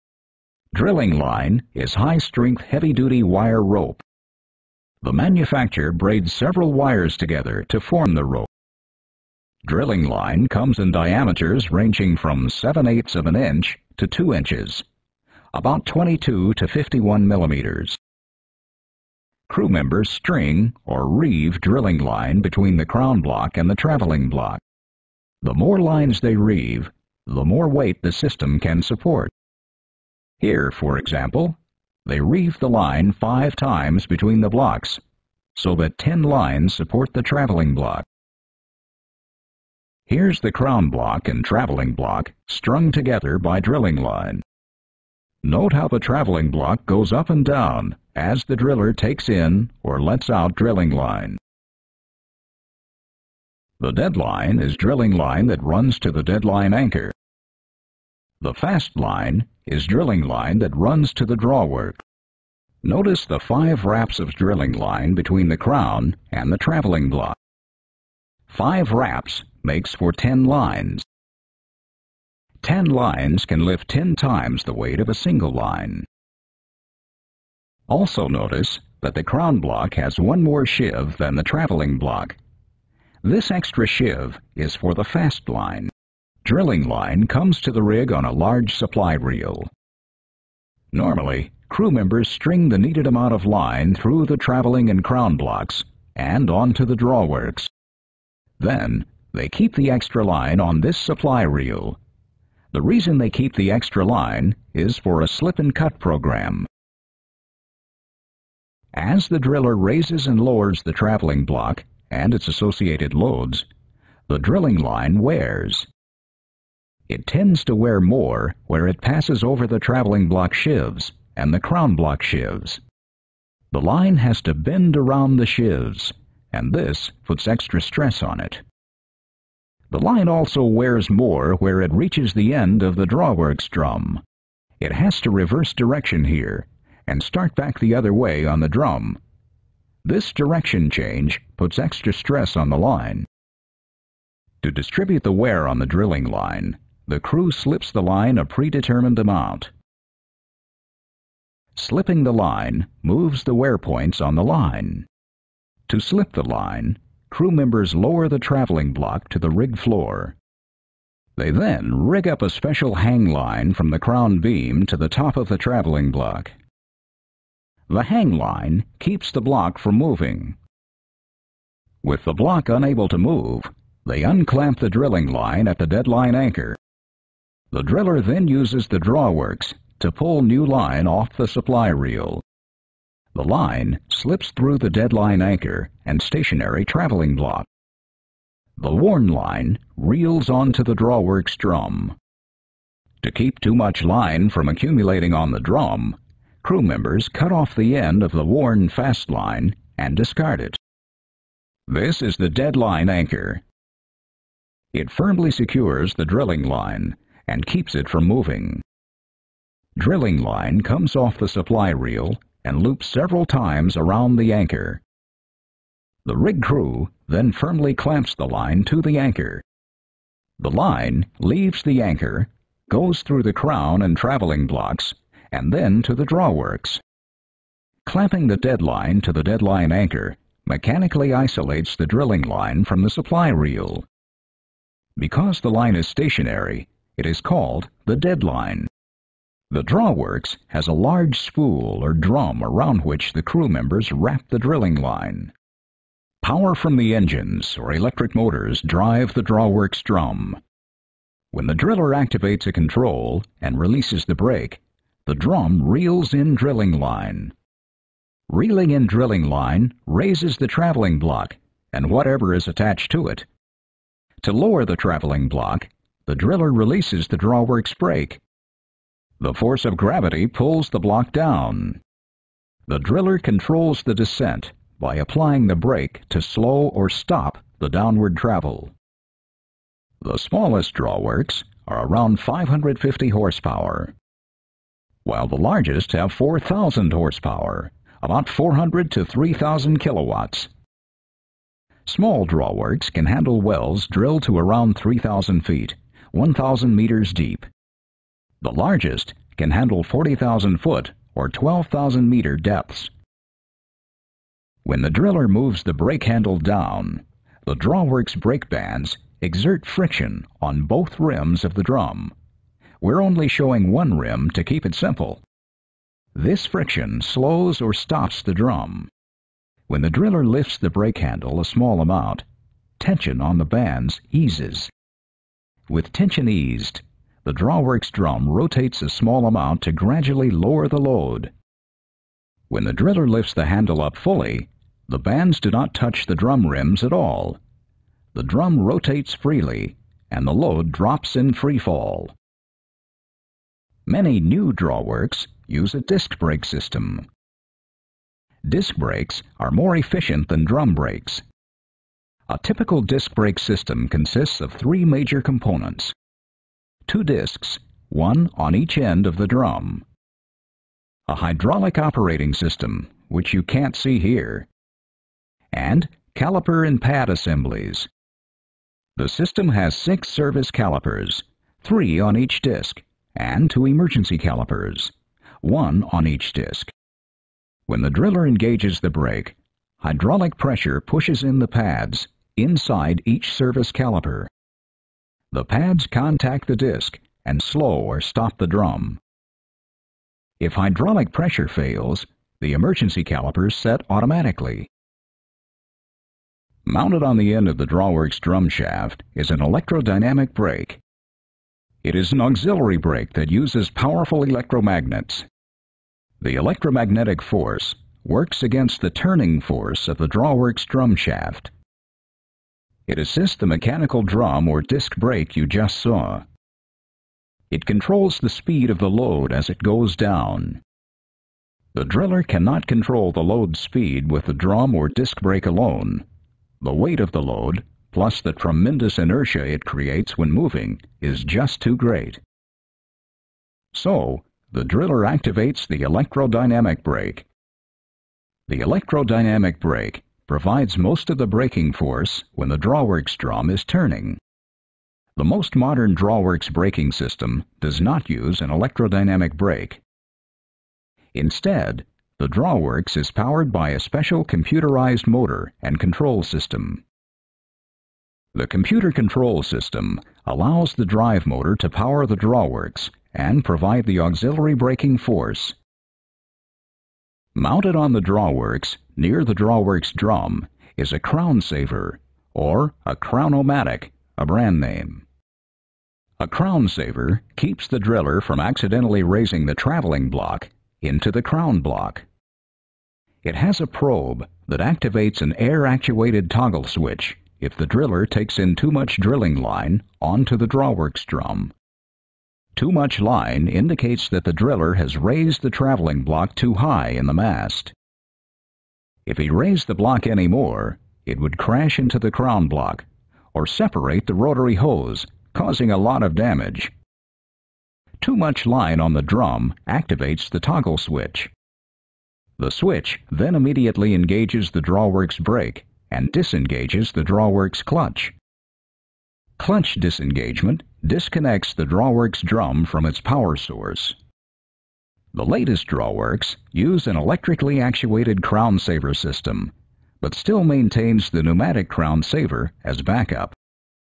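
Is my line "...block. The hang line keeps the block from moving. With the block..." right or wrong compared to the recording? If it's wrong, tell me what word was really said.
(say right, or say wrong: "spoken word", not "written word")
right.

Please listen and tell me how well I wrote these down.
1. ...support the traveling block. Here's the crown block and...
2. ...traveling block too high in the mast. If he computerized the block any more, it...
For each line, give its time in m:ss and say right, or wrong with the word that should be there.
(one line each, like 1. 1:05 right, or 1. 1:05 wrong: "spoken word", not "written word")
1. 0:36 right
2. 8:15 wrong: "raised", not "computerized".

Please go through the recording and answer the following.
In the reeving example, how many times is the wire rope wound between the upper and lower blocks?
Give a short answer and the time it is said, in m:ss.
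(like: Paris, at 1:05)
5, at 0:33.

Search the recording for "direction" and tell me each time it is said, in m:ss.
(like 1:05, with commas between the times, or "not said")
2:15, 2:20.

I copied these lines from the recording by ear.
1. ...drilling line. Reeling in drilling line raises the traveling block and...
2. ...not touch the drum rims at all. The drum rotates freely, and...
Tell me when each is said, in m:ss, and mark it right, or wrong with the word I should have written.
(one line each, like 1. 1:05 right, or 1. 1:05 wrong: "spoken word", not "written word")
1. 4:16 right
2. 5:35 right.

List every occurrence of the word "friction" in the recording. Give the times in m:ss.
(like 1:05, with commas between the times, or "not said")
5:09, 5:16.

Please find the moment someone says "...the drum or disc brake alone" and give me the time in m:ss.
7:04.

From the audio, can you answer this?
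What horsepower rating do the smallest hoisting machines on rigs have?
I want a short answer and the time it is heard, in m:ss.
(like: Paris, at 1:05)
550 horsepower, at 4:42.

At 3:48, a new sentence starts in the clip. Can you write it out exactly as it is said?
Clamping the deadline to the deadline anchor mechanically isolates the drilling line from the supply reel.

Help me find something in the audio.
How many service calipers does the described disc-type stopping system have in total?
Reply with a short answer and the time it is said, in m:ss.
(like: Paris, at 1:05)
6, at 6:09.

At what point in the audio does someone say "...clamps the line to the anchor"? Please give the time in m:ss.
3:37.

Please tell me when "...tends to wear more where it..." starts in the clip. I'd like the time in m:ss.
1:57.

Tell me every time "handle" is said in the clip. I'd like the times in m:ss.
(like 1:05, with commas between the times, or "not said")
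4:53, 4:59, 5:06, 5:21, 5:33.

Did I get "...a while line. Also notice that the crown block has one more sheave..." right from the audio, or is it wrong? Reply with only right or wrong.
wrong.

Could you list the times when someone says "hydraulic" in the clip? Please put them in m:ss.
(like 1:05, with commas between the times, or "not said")
6:01, 6:19, 6:30.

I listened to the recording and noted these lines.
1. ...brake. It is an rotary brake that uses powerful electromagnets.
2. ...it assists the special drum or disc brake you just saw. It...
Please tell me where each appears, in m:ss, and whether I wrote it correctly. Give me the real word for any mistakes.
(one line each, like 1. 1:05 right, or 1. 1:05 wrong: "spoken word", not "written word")
1. 6:40 wrong: "auxiliary", not "rotary"
2. 6:53 wrong: "mechanical", not "special".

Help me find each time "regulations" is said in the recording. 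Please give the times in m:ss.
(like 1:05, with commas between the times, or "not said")
not said.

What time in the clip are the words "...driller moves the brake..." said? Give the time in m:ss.
5:05.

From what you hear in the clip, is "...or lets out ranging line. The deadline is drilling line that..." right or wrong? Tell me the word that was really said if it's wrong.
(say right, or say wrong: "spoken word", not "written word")
wrong: "drilling", not "ranging".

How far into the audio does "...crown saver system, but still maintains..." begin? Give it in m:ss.
8:48.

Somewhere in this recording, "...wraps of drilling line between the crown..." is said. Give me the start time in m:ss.
1:03.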